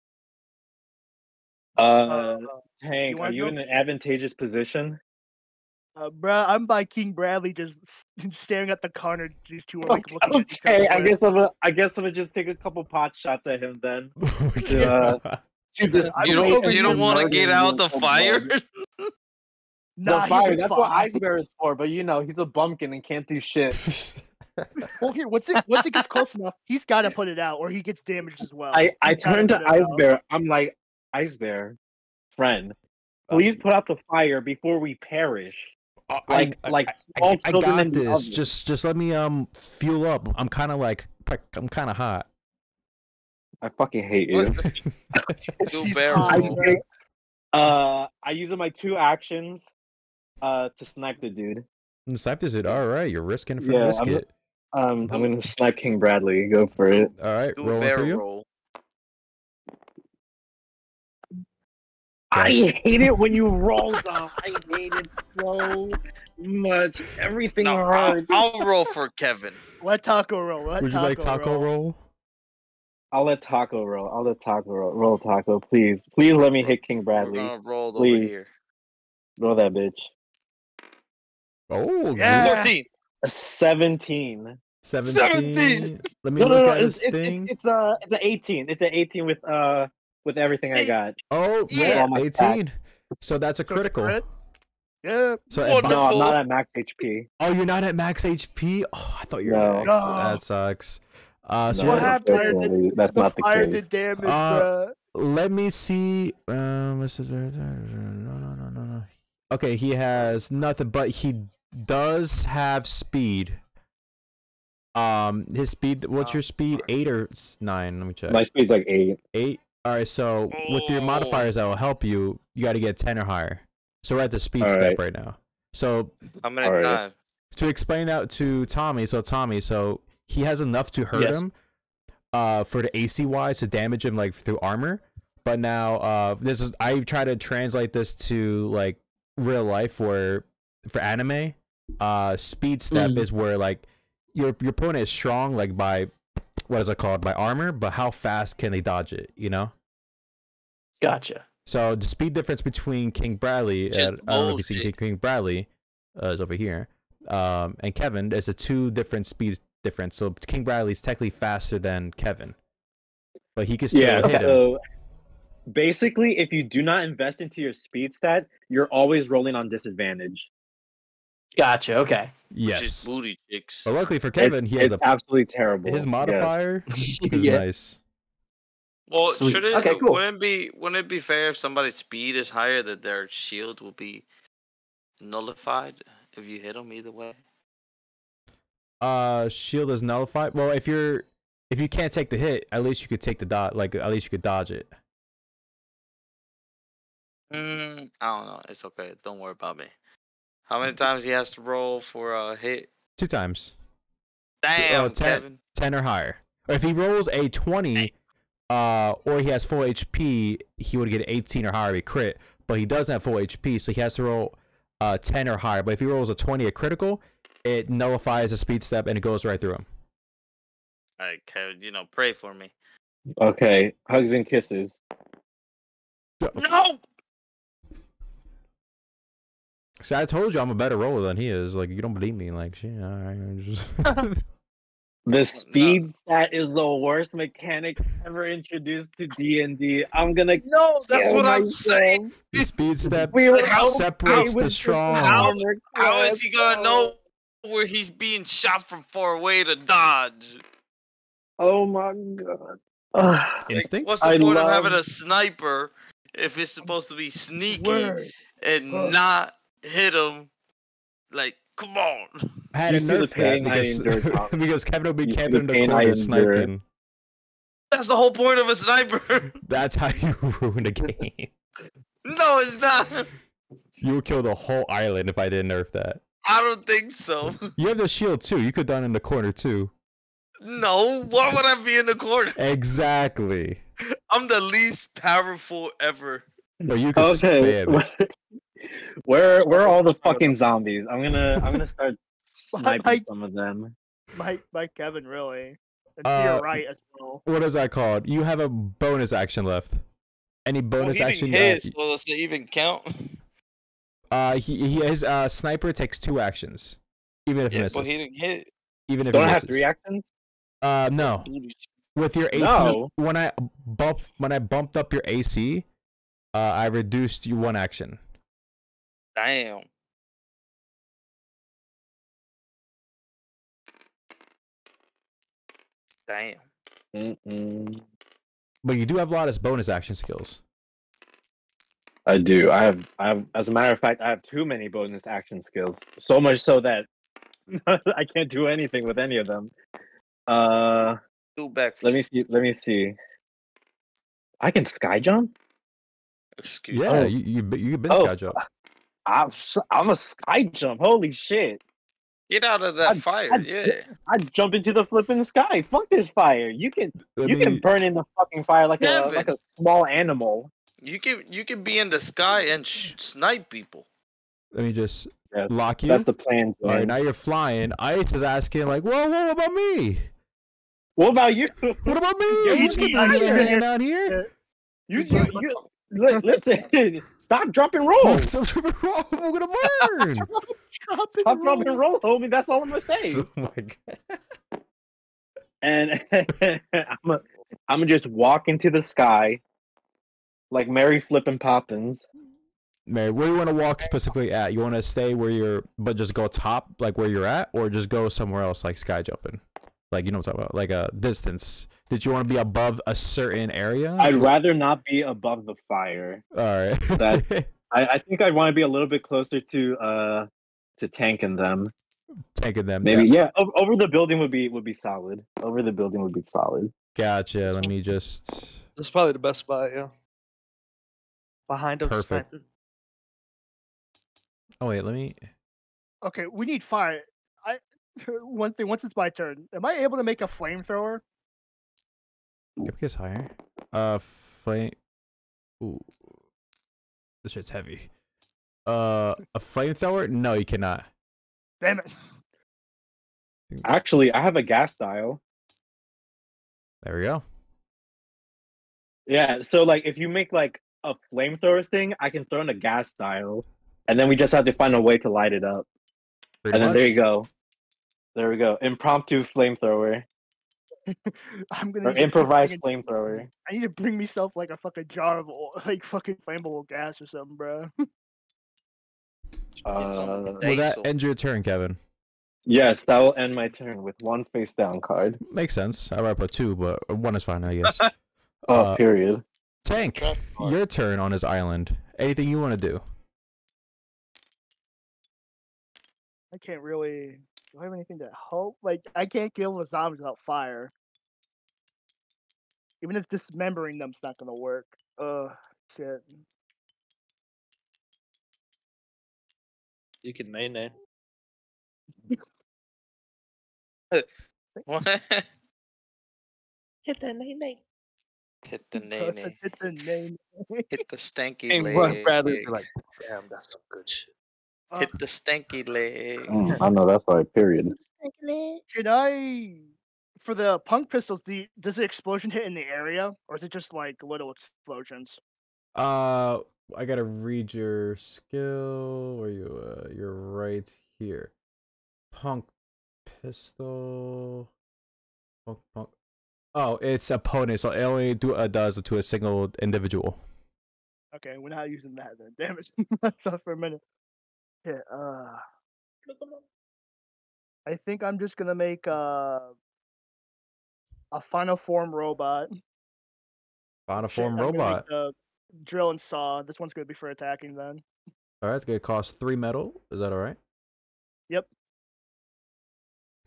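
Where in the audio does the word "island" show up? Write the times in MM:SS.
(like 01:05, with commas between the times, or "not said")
04:34, 08:01.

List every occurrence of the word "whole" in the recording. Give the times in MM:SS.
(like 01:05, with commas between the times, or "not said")
04:28, 04:34.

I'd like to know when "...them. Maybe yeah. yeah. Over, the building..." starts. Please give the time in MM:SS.
06:52.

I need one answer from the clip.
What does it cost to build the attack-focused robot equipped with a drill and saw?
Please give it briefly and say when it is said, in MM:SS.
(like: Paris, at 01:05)
3 metal, at 09:19.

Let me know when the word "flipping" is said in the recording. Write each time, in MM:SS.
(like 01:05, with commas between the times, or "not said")
05:55, 06:31.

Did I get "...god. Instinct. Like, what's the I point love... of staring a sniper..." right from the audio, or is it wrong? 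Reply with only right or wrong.
wrong.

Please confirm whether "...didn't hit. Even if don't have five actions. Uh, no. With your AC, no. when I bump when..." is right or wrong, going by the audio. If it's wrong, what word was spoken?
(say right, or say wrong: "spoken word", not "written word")
wrong: "three", not "five".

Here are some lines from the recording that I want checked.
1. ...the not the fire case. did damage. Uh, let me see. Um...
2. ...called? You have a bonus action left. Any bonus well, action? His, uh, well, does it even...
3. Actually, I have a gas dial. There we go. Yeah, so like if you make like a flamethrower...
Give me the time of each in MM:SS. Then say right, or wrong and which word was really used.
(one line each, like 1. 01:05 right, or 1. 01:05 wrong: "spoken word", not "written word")
1. 01:43 right
2. 04:57 right
3. 07:23 right.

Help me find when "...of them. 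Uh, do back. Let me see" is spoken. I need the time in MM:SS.
05:39.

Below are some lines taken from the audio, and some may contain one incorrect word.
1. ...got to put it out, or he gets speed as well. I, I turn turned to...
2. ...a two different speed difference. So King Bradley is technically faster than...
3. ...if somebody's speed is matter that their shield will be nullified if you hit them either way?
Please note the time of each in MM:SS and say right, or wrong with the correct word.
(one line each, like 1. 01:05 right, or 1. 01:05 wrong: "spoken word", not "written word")
1. 00:26 wrong: "damaged", not "speed"
2. 02:38 right
3. 03:01 wrong: "higher", not "matter".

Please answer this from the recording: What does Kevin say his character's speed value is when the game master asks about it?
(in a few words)
8.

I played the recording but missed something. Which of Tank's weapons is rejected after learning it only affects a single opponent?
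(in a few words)
Punk pistols.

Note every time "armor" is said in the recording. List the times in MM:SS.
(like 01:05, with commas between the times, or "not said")
02:14, 02:27.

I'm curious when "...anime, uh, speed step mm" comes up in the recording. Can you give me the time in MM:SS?
02:21.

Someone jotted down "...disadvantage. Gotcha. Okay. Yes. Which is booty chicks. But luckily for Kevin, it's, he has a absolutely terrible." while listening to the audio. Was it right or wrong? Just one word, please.
right.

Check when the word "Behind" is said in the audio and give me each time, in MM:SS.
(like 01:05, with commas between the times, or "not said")
07:01.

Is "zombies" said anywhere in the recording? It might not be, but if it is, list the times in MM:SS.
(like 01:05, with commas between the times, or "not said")
04:50, 08:09.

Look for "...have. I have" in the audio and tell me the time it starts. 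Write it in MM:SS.
05:32.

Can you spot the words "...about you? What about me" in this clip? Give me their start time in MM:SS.
06:11.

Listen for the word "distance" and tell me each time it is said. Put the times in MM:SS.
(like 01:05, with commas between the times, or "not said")
06:41.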